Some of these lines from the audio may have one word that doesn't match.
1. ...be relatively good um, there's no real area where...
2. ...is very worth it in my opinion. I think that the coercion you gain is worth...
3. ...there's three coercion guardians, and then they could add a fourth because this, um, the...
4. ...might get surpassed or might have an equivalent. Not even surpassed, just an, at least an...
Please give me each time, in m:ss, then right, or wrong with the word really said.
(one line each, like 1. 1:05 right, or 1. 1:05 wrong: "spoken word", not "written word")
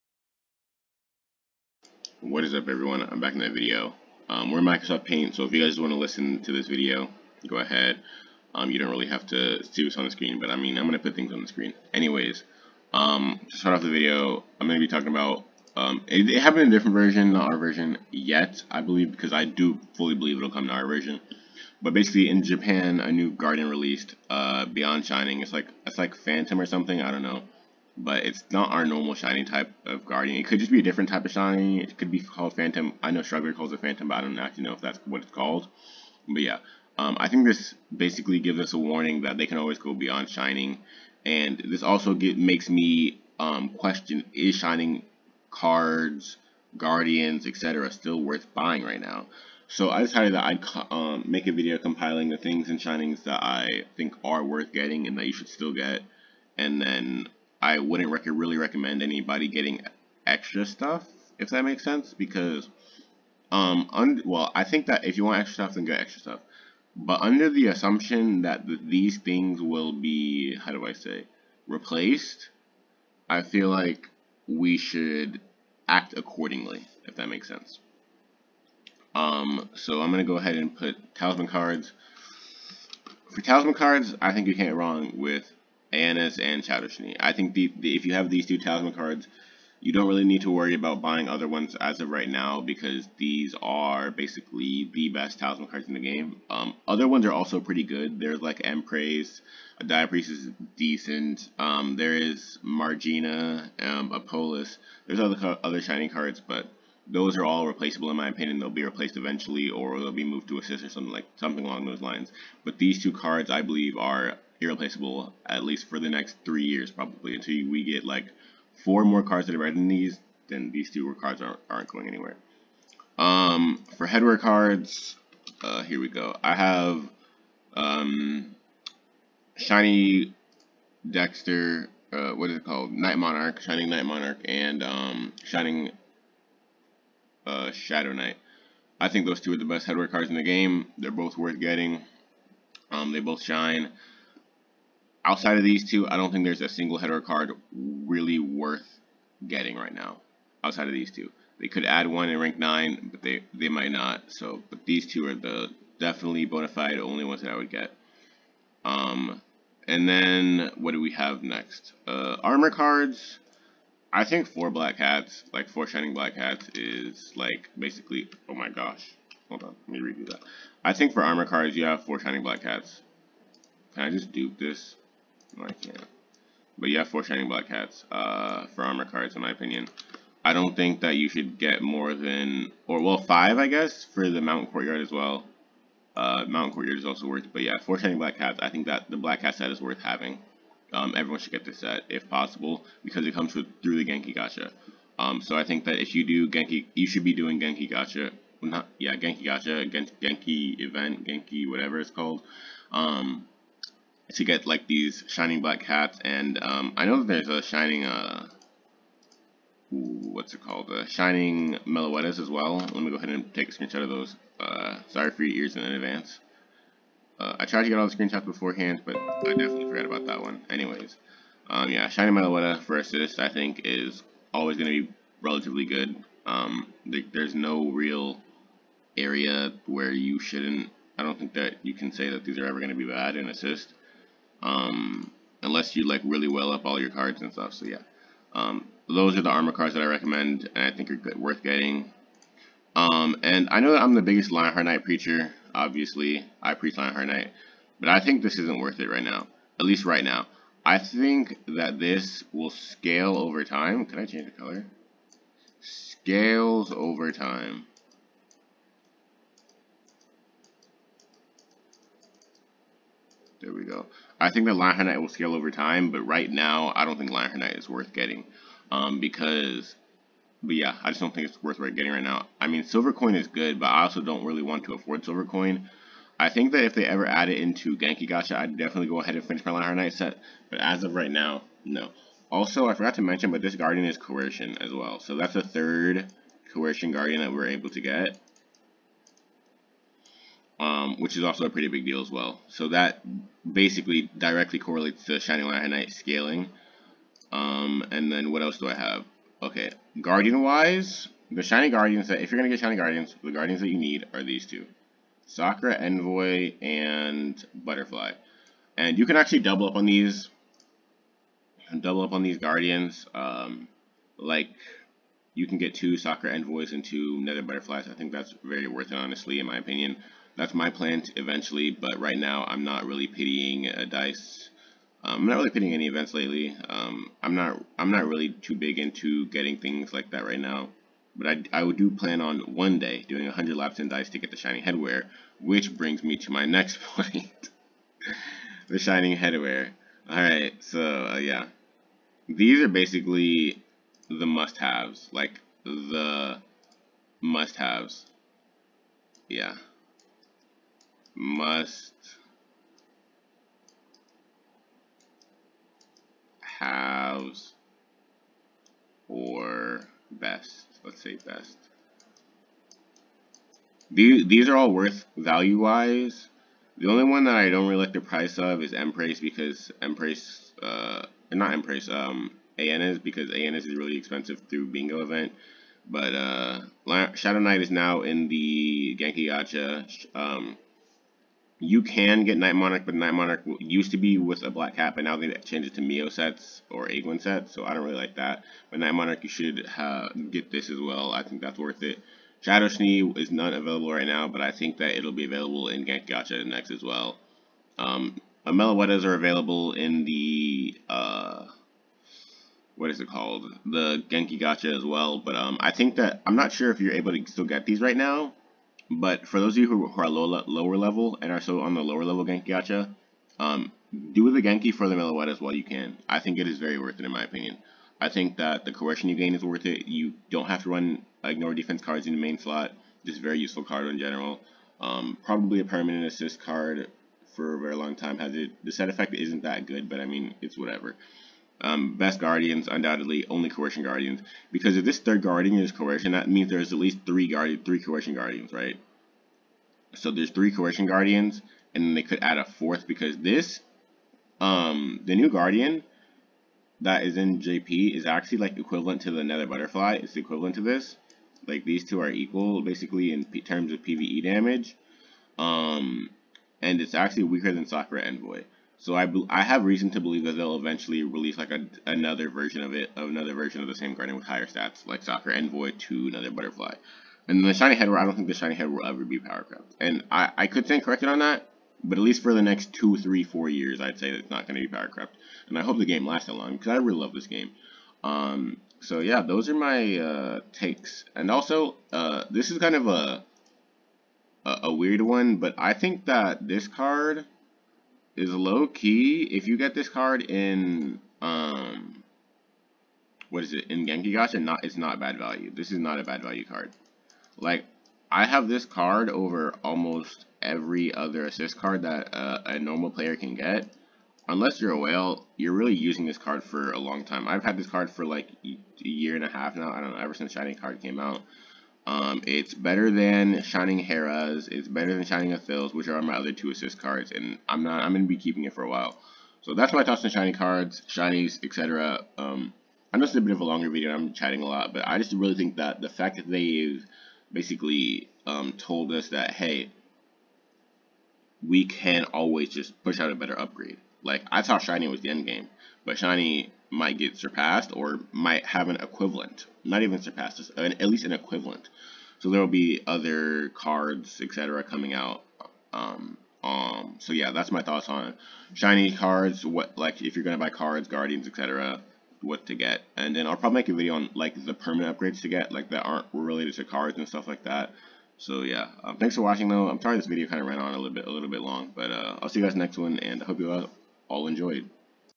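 1. 3:45 right
2. 6:56 right
3. 7:20 right
4. 8:56 right.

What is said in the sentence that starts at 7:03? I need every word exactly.
Just very useful card in general.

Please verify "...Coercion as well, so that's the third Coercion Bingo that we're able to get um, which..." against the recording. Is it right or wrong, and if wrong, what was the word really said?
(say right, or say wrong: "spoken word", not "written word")
wrong: "Guardian", not "Bingo".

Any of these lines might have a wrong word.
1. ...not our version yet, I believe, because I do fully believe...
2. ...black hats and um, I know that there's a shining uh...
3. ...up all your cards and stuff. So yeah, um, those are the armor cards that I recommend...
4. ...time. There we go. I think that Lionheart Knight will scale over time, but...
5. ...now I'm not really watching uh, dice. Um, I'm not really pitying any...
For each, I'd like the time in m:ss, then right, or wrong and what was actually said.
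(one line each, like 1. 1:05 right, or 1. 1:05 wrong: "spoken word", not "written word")
1. 0:17 right
2. 3:25 right
3. 3:56 right
4. 4:17 right
5. 5:22 wrong: "pitying", not "watching".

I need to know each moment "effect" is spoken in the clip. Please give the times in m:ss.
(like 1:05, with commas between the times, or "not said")
7:09.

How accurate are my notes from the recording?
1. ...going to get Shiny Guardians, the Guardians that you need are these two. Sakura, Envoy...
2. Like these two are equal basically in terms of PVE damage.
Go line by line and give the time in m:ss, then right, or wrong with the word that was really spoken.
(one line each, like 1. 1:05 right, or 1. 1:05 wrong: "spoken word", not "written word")
1. 5:02 right
2. 7:31 right.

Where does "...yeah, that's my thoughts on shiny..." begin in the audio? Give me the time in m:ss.
9:07.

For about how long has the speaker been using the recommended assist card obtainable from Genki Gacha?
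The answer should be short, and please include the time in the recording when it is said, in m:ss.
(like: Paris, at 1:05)
A year and a half, at 8:28.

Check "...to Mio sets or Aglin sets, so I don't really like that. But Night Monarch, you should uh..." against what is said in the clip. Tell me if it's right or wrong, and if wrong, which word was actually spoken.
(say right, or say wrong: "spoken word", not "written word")
right.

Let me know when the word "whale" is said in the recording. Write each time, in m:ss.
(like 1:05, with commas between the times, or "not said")
8:24.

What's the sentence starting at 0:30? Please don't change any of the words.
It could just be a different type of shiny.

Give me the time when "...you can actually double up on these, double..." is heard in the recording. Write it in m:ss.
5:09.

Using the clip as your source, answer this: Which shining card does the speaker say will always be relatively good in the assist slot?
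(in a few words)
Shining Meloeta.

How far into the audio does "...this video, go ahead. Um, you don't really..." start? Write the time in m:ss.
0:06.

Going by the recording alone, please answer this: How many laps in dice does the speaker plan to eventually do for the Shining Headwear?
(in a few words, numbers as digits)
100.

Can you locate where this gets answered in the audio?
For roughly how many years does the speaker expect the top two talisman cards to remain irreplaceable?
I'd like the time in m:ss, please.
1:56.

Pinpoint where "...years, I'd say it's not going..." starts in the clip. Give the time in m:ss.
7:53.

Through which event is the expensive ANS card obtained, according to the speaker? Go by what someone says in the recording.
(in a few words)
Bingo event.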